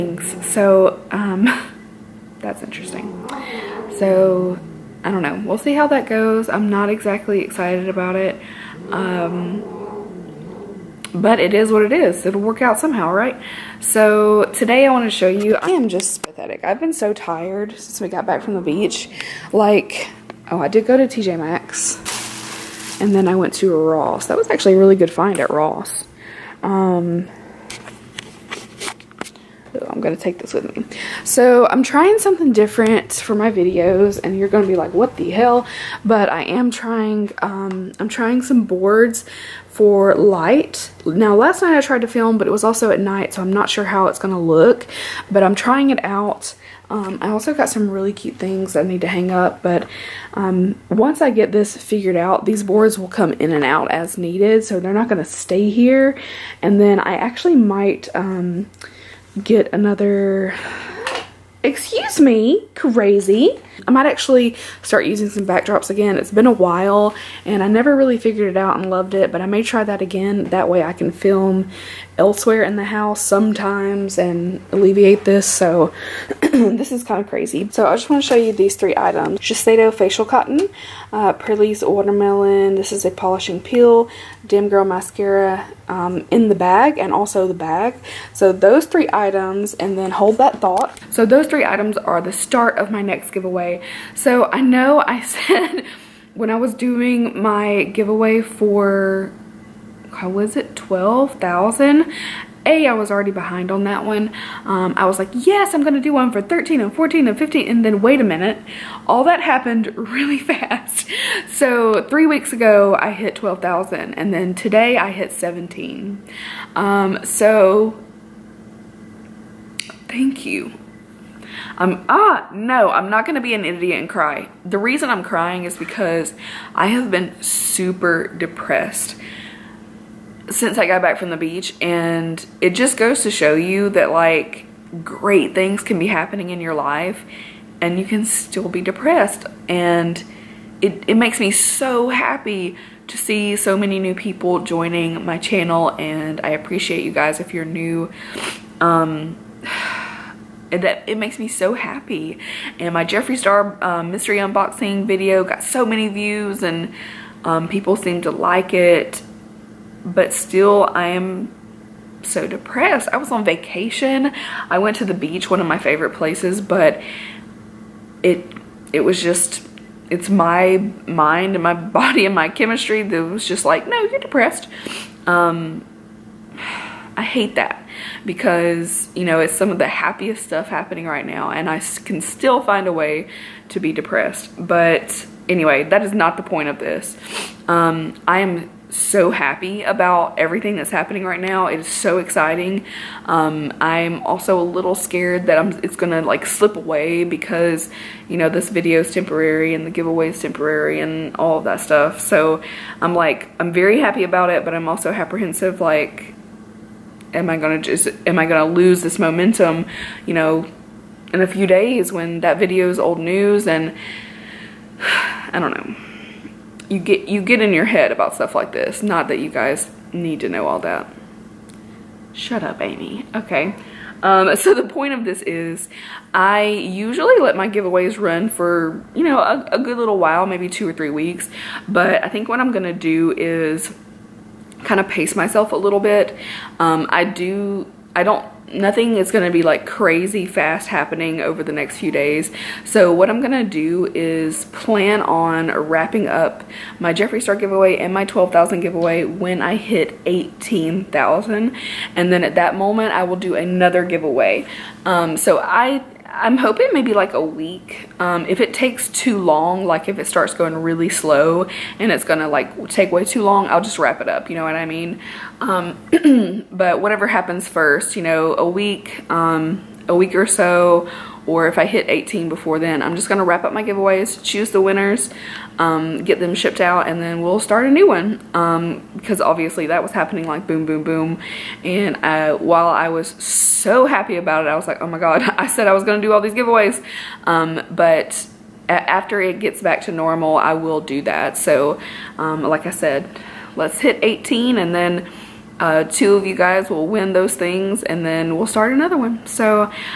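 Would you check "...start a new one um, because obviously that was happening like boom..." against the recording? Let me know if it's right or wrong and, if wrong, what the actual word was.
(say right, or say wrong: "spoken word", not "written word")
right.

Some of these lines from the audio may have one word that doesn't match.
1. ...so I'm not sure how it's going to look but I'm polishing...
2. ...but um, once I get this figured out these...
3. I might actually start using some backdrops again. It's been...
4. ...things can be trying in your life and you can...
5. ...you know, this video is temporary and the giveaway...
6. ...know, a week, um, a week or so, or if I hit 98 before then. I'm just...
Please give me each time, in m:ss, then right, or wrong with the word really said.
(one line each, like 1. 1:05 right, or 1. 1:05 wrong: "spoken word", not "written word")
1. 0:43 wrong: "trying", not "polishing"
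2. 0:49 right
3. 1:03 right
4. 2:15 wrong: "happening", not "trying"
5. 3:18 right
6. 4:28 wrong: "18", not "98".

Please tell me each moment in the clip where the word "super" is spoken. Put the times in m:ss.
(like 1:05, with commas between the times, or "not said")
2:07.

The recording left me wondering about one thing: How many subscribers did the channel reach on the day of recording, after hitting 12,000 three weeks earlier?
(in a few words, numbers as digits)
17,000.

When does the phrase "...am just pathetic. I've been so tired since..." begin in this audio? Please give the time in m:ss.
0:15.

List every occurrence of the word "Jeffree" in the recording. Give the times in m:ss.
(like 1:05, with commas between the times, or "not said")
2:33, 4:07.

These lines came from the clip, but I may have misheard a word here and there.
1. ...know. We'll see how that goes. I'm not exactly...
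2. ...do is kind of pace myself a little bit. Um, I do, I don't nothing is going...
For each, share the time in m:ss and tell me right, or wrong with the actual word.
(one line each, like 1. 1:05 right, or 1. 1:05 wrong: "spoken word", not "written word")
1. 0:05 right
2. 3:52 right.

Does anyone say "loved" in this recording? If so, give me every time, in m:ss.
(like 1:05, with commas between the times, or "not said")
1:08.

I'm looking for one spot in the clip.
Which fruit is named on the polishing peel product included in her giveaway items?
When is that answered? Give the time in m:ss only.
1:21.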